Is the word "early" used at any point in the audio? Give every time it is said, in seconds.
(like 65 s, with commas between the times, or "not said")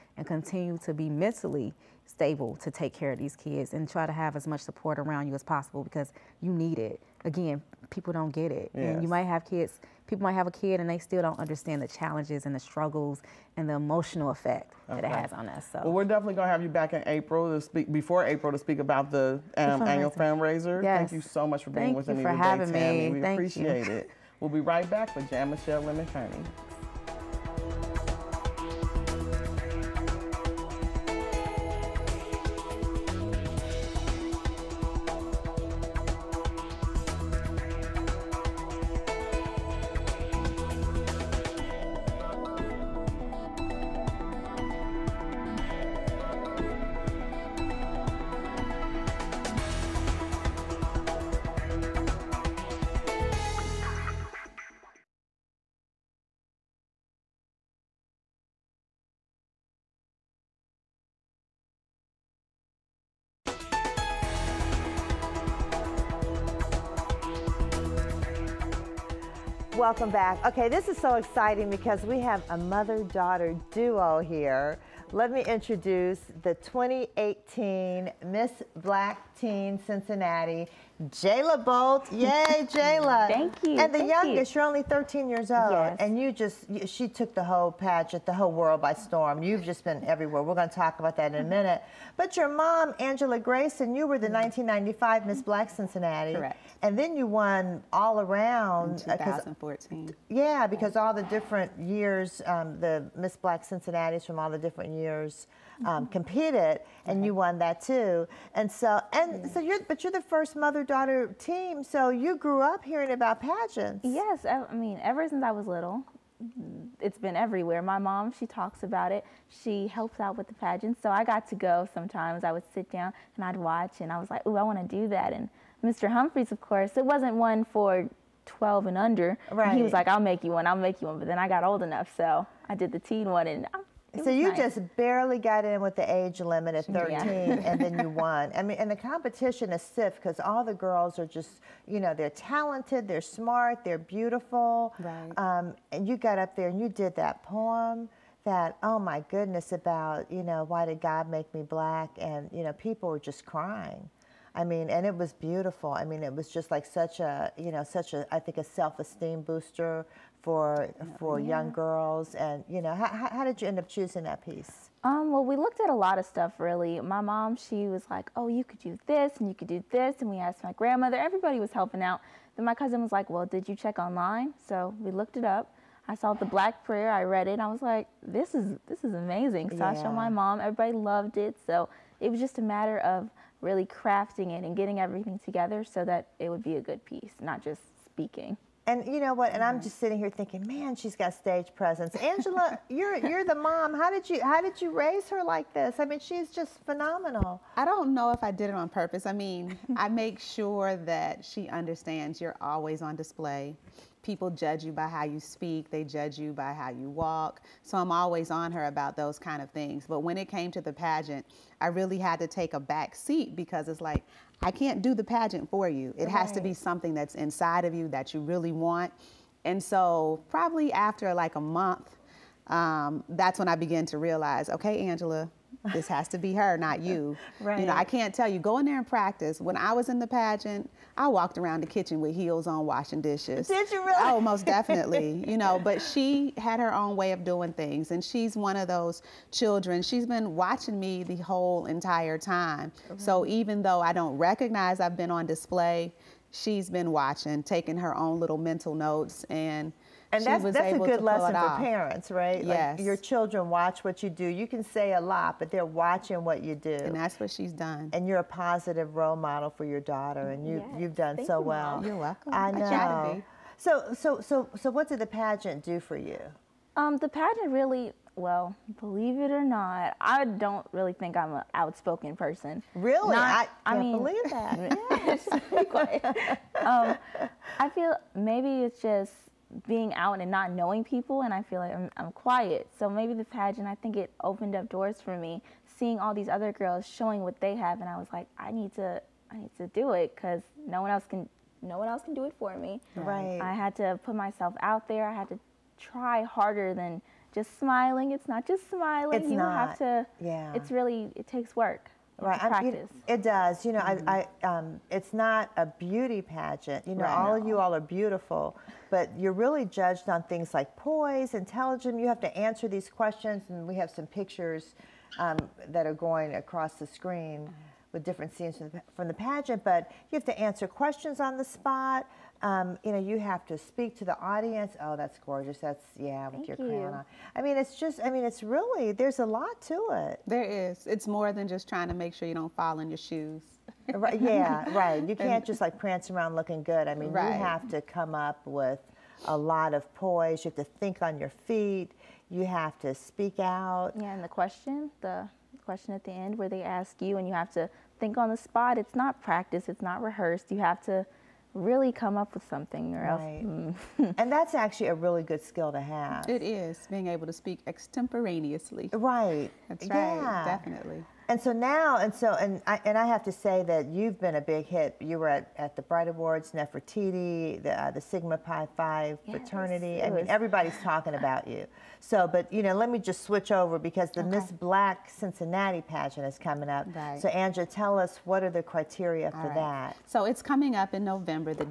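not said.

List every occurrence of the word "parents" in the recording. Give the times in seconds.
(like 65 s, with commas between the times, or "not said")
251 s.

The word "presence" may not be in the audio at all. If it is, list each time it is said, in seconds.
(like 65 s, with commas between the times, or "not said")
191 s.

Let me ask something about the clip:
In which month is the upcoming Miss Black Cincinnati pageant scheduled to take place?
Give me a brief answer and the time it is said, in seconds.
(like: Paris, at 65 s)
November, at 381 s.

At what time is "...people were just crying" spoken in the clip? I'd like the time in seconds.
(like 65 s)
152 s.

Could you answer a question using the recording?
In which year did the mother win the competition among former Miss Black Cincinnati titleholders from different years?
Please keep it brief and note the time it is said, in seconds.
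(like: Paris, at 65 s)
2014, at 99 s.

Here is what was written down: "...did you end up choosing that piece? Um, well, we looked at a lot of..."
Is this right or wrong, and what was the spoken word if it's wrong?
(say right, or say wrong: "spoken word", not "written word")
right.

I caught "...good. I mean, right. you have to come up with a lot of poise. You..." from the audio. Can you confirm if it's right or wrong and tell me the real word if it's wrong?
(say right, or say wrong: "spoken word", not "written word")
right.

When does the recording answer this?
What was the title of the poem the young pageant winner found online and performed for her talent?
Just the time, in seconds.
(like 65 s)
176 s.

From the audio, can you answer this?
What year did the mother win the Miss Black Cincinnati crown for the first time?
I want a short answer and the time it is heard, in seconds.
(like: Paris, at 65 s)
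1995, at 94 s.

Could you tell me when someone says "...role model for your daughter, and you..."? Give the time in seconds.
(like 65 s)
259 s.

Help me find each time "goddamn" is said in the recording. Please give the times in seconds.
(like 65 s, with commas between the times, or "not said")
not said.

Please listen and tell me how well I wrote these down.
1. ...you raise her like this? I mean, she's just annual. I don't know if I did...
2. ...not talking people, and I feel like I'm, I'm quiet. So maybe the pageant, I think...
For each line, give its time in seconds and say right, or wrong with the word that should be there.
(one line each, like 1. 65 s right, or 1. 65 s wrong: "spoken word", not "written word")
1. 194 s wrong: "phenomenal", not "annual"
2. 280 s wrong: "knowing", not "talking".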